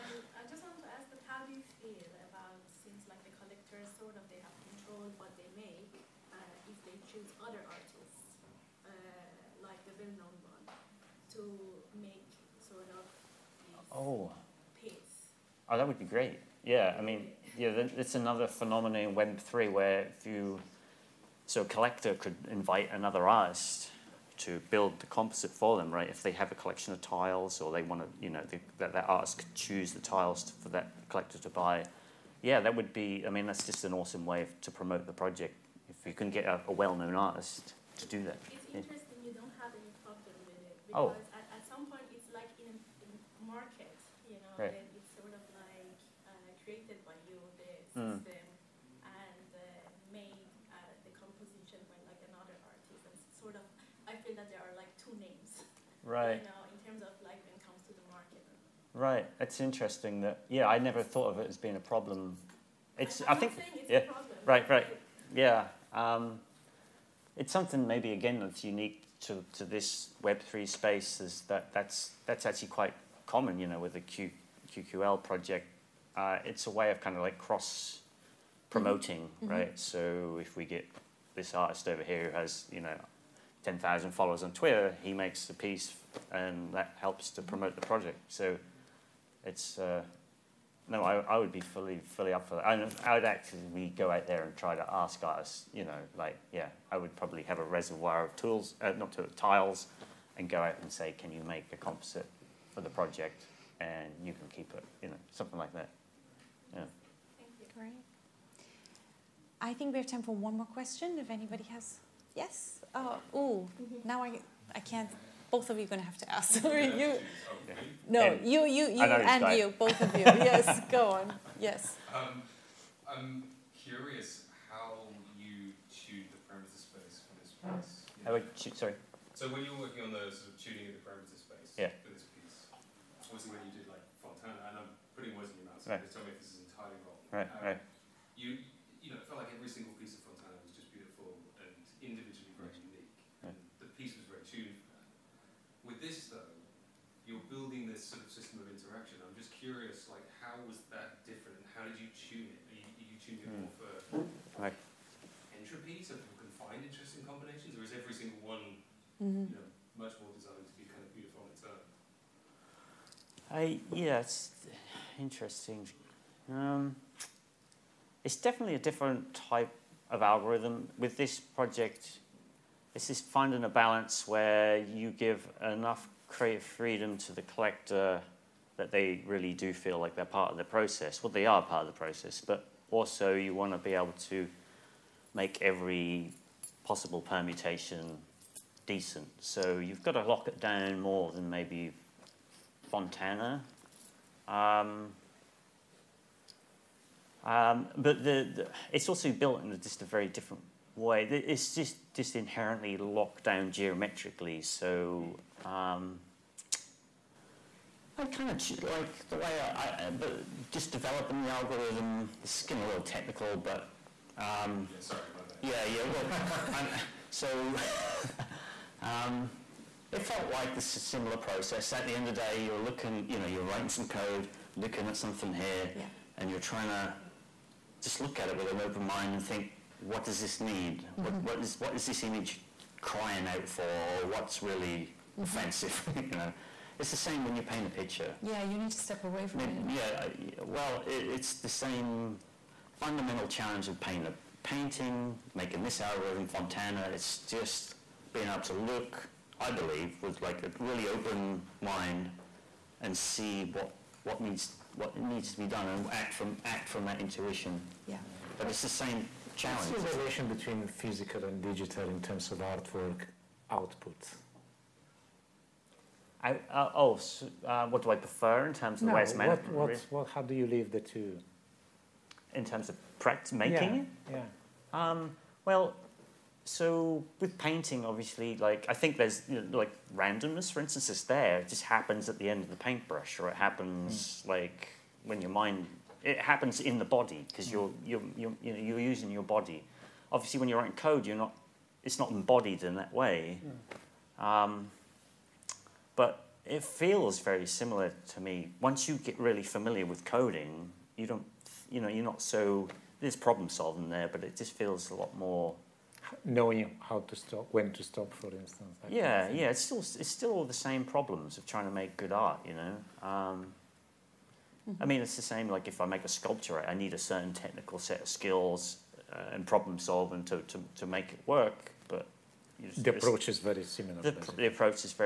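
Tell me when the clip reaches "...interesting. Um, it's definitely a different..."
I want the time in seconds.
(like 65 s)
165 s.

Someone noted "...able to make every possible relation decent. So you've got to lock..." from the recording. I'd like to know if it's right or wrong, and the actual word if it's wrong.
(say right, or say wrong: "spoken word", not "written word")
wrong: "permutation", not "relation".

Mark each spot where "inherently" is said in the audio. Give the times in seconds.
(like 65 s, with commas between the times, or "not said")
202 s.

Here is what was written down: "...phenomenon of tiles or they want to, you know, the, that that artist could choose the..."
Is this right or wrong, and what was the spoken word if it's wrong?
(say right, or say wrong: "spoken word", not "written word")
wrong: "collection", not "phenomenon".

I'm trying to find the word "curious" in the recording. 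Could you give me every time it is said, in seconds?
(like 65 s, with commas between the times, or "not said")
123 s, 149 s.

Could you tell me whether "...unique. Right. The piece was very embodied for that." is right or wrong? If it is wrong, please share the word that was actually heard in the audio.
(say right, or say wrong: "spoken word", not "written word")
wrong: "tuned", not "embodied".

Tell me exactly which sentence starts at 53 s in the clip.
And sort of, I feel that there are like two names.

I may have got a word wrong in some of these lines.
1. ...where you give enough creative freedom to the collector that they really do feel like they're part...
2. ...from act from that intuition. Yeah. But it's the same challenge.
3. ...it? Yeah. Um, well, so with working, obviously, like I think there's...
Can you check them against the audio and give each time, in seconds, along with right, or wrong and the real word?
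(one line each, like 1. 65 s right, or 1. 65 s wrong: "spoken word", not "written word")
1. 174 s right
2. 256 s right
3. 274 s wrong: "painting", not "working".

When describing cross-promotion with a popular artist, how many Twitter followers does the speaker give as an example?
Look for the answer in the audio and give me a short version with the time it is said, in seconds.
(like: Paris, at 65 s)
10,000, at 83 s.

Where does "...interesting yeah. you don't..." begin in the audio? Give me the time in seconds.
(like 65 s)
38 s.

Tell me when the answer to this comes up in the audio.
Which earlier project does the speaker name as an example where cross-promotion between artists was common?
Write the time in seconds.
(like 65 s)
74 s.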